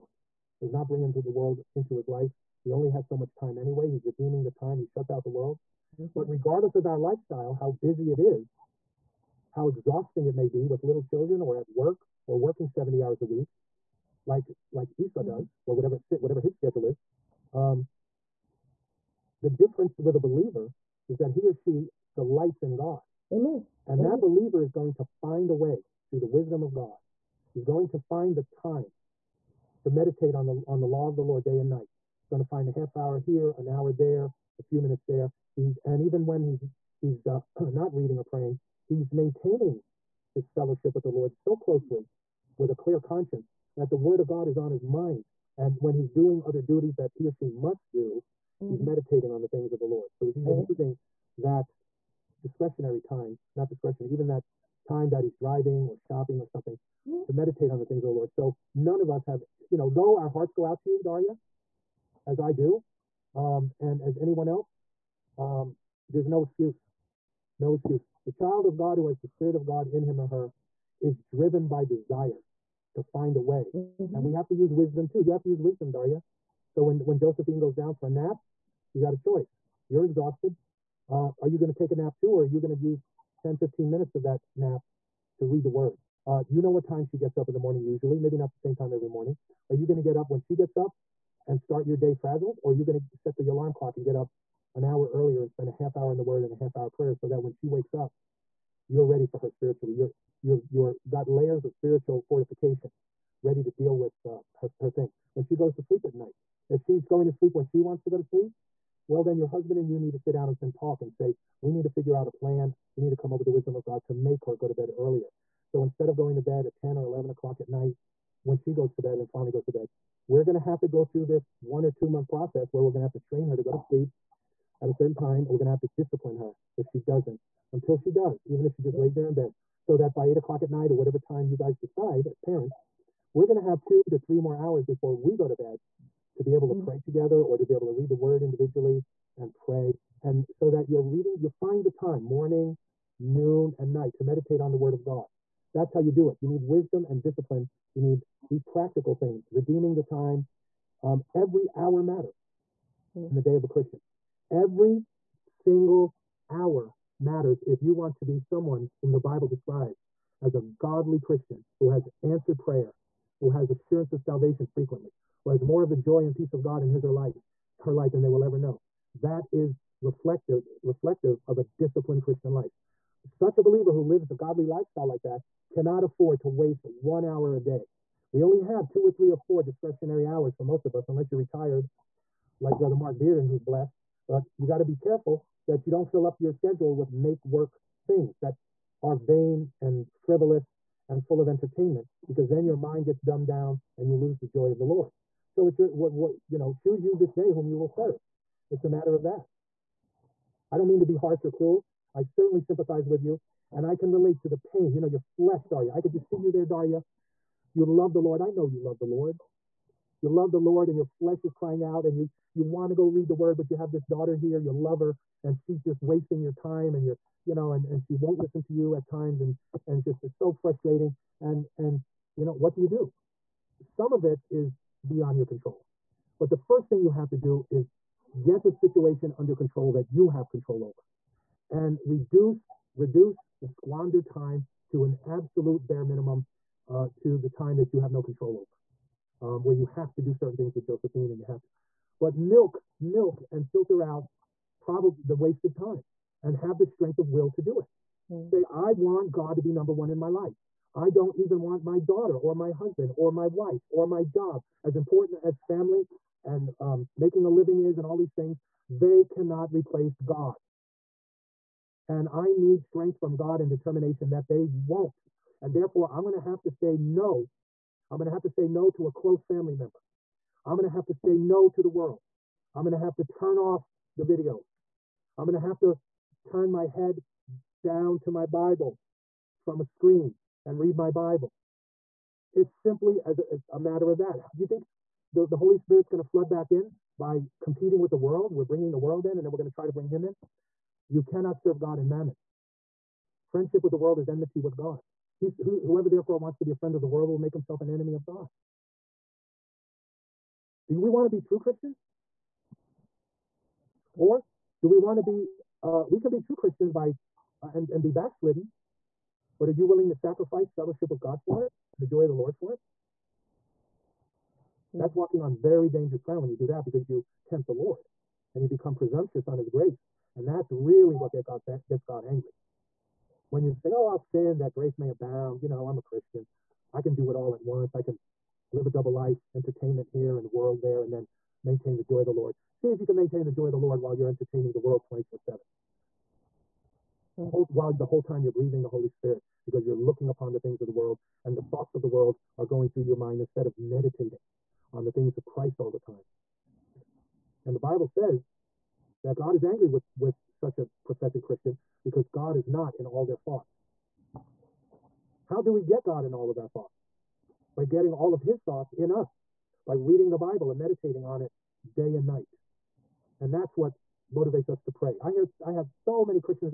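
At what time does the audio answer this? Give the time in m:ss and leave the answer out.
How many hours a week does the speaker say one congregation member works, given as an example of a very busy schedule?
0:12.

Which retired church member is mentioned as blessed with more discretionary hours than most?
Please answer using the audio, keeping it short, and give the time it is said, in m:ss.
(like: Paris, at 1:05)
Mark Bearden, at 3:02.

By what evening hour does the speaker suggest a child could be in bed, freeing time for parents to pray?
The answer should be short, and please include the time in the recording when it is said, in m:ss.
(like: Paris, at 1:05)
8 o'clock, at 2:10.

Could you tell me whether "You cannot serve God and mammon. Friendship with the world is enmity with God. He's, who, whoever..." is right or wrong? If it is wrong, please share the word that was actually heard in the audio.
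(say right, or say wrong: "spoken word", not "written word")
right.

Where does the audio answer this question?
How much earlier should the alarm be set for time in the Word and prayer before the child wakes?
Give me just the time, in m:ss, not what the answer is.
1:34.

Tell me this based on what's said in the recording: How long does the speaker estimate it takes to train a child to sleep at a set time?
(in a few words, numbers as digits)
one or two month.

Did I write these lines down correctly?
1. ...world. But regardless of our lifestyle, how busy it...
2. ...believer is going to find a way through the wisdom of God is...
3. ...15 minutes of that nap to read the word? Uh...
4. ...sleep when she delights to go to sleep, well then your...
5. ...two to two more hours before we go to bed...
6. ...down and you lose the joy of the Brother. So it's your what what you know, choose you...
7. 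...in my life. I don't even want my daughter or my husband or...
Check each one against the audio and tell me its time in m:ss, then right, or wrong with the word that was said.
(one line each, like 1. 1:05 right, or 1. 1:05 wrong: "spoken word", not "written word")
1. 0:05 right
2. 0:24 right
3. 1:23 right
4. 1:47 wrong: "wants", not "delights"
5. 2:13 wrong: "three", not "two"
6. 3:13 wrong: "Lord", not "Brother"
7. 4:10 right.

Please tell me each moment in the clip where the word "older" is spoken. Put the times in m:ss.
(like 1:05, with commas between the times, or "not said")
not said.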